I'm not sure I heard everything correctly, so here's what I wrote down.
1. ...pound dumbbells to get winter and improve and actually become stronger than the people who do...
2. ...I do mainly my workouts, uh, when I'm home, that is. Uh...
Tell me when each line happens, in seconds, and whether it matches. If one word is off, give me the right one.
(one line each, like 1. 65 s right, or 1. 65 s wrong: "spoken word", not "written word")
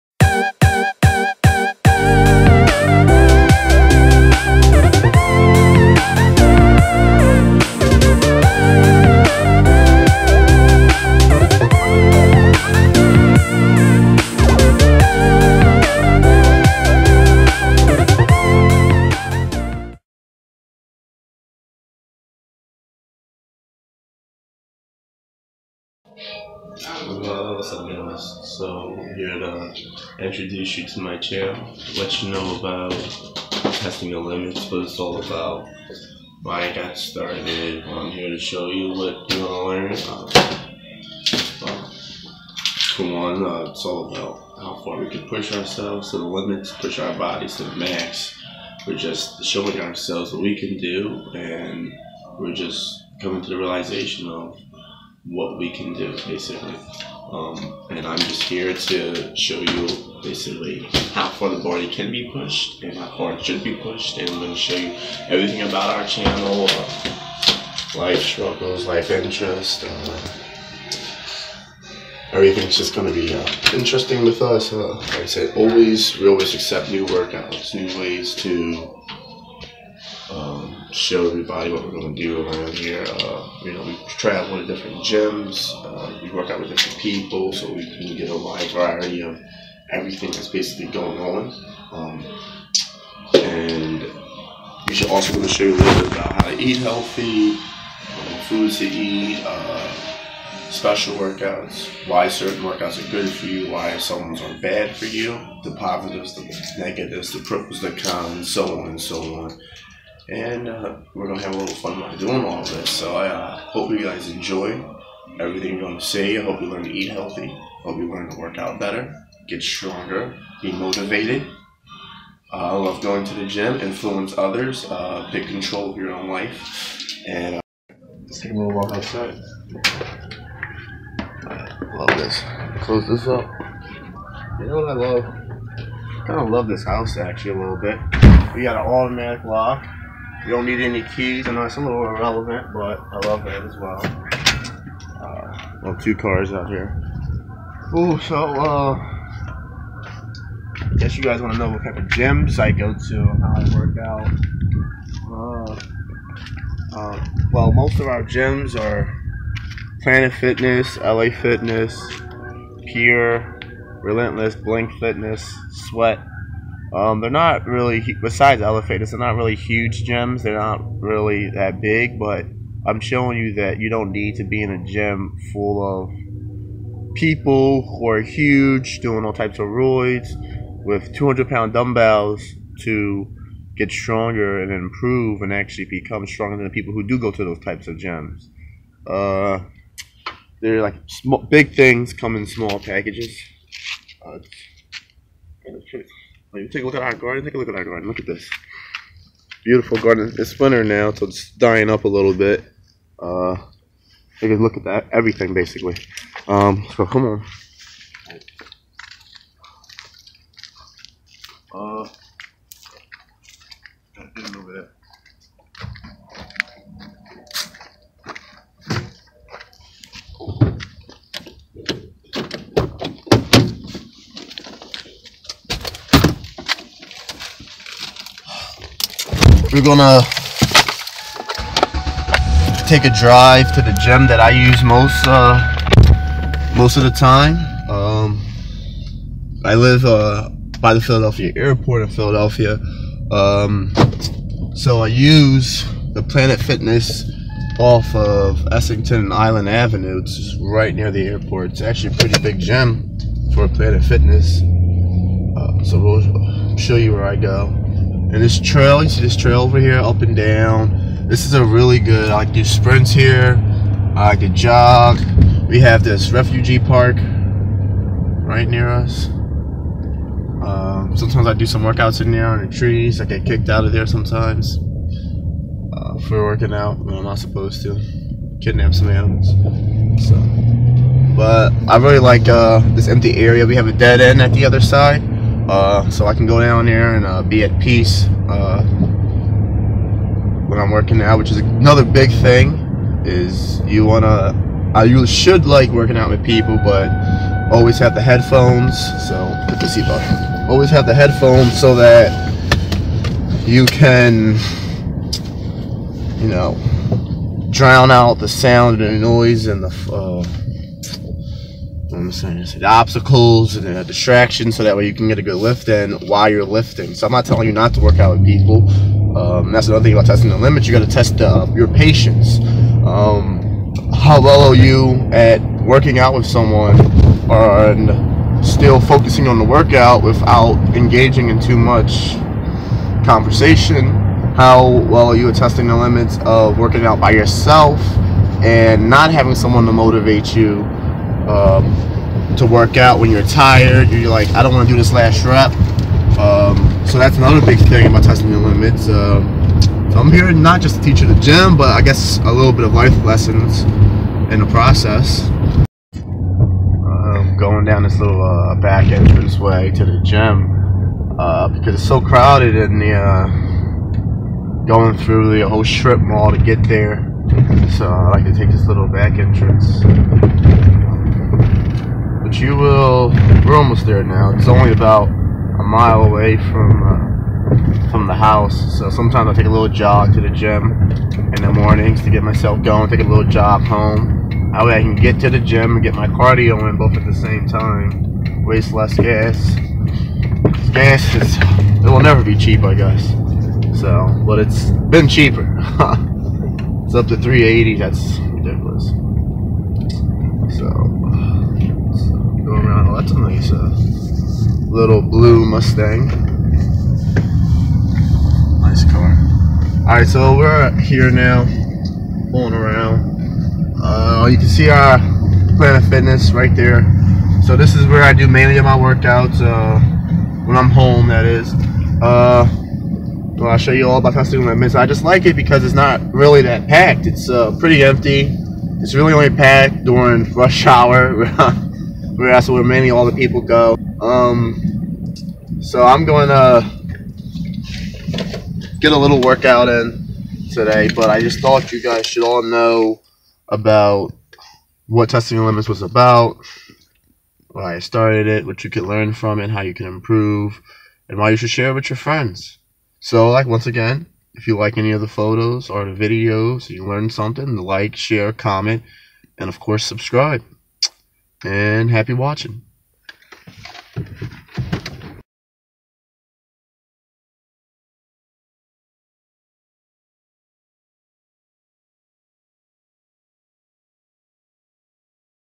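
1. 181 s wrong: "stronger", not "winter"
2. 418 s right.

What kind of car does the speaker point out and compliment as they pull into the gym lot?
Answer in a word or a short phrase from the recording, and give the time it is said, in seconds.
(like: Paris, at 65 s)
Blue Mustang, at 405 s.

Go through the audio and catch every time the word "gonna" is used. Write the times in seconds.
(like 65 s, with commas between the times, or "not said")
111 s, 115 s, 229 s.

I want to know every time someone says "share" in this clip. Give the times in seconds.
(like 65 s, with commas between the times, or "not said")
451 s, 458 s.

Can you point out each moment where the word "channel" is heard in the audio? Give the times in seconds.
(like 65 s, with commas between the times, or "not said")
31 s, 66 s.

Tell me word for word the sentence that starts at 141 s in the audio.
I know it's a little irrelevant, but I love it as well.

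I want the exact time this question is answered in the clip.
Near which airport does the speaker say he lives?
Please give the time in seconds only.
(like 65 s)
240 s.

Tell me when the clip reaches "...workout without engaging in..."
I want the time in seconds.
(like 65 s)
329 s.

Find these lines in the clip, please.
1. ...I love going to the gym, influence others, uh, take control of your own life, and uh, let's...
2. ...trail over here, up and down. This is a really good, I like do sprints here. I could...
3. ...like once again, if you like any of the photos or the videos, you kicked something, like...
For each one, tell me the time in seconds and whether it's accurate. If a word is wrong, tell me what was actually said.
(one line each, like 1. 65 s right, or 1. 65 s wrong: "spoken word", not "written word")
1. 122 s right
2. 259 s right
3. 453 s wrong: "learned", not "kicked".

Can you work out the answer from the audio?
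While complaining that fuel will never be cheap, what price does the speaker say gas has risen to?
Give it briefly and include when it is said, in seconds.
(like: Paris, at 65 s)
3.80, at 397 s.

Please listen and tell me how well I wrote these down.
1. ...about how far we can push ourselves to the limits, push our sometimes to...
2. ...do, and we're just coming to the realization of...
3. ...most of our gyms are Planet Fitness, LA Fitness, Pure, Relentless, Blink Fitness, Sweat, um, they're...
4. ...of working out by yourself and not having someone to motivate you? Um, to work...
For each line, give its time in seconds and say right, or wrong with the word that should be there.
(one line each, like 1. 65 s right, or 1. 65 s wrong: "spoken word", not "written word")
1. 44 s wrong: "bodies", not "sometimes"
2. 50 s right
3. 157 s right
4. 336 s right.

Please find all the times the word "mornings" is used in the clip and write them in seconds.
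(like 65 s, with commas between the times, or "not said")
381 s.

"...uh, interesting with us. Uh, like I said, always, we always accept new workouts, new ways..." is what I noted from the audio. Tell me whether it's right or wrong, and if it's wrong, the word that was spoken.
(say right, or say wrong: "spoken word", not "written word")
right.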